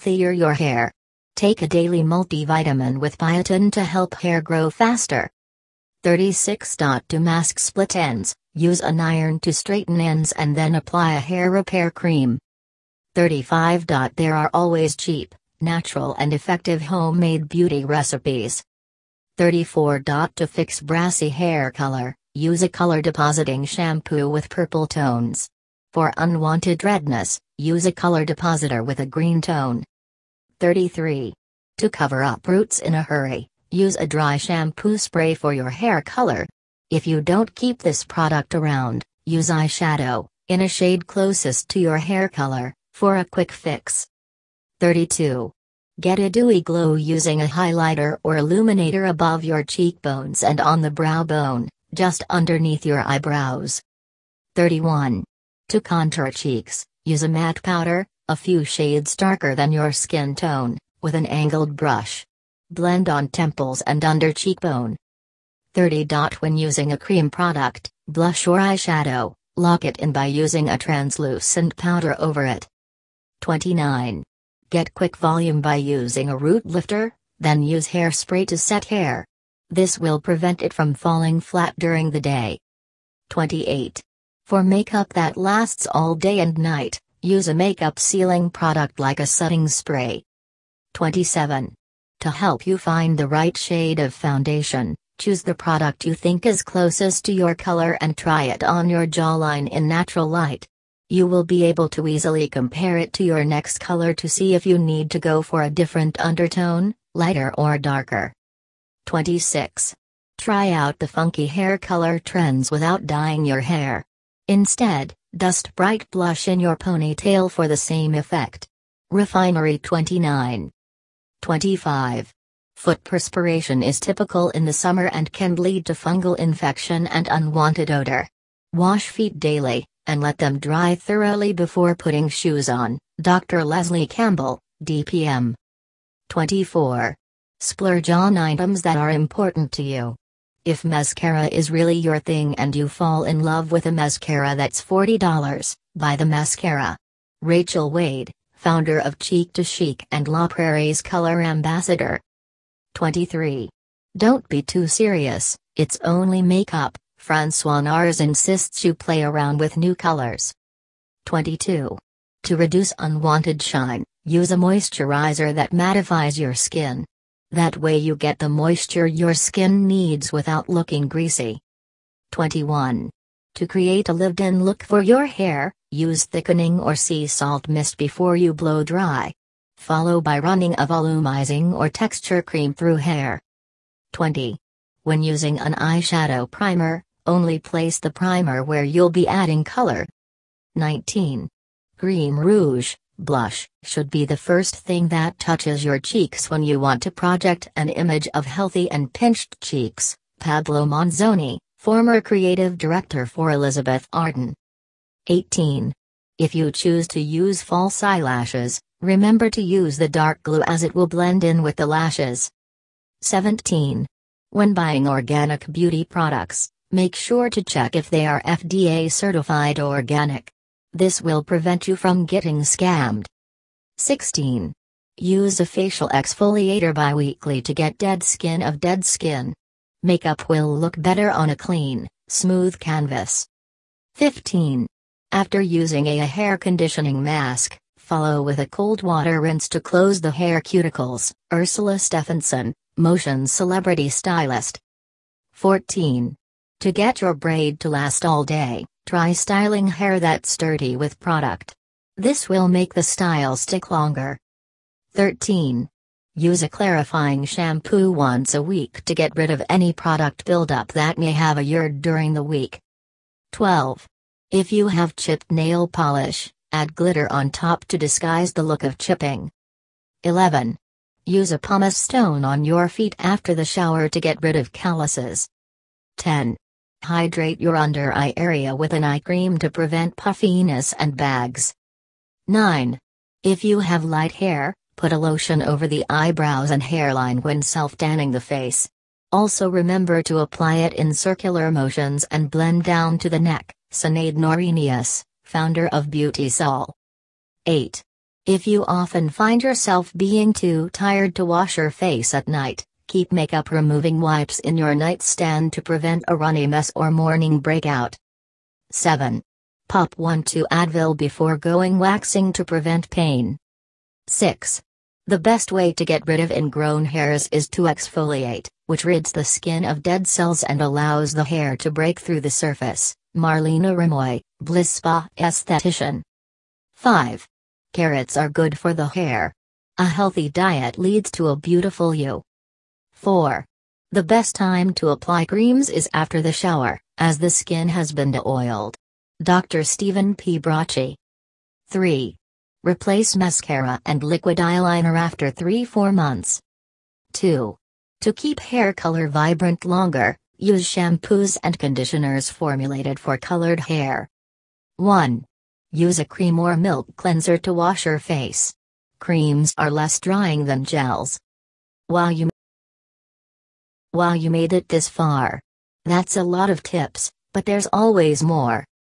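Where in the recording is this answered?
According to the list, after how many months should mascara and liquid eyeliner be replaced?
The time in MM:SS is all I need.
05:45.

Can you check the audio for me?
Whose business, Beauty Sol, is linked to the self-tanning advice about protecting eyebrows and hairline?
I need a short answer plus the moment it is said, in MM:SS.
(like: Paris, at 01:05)
Sinead Norenius, at 04:53.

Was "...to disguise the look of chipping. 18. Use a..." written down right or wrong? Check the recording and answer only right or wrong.
wrong.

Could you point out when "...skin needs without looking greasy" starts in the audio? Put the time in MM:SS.
02:49.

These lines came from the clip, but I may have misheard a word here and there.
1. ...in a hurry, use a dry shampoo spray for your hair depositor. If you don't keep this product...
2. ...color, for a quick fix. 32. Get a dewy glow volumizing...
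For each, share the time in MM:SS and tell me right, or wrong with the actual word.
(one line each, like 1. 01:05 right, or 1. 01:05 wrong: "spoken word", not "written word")
1. 00:32 wrong: "color", not "depositor"
2. 00:42 wrong: "using", not "volumizing".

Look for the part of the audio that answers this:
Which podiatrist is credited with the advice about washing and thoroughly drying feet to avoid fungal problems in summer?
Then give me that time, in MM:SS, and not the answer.
02:13.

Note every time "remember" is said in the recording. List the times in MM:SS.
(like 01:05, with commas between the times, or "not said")
03:29, 04:49.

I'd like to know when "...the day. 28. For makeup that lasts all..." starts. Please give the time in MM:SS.
01:22.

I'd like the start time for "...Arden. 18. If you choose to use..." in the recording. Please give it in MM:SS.
03:24.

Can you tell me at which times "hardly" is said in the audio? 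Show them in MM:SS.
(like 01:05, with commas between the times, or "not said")
not said.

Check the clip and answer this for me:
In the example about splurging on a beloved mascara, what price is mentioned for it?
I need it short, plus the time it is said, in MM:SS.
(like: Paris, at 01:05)
$40, at 02:24.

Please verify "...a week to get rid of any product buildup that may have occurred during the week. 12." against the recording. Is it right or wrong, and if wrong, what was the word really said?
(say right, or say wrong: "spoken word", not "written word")
right.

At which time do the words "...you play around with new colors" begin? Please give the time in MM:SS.
02:38.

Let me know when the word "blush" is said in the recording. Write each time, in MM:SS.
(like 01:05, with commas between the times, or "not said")
01:08, 01:56, 03:13.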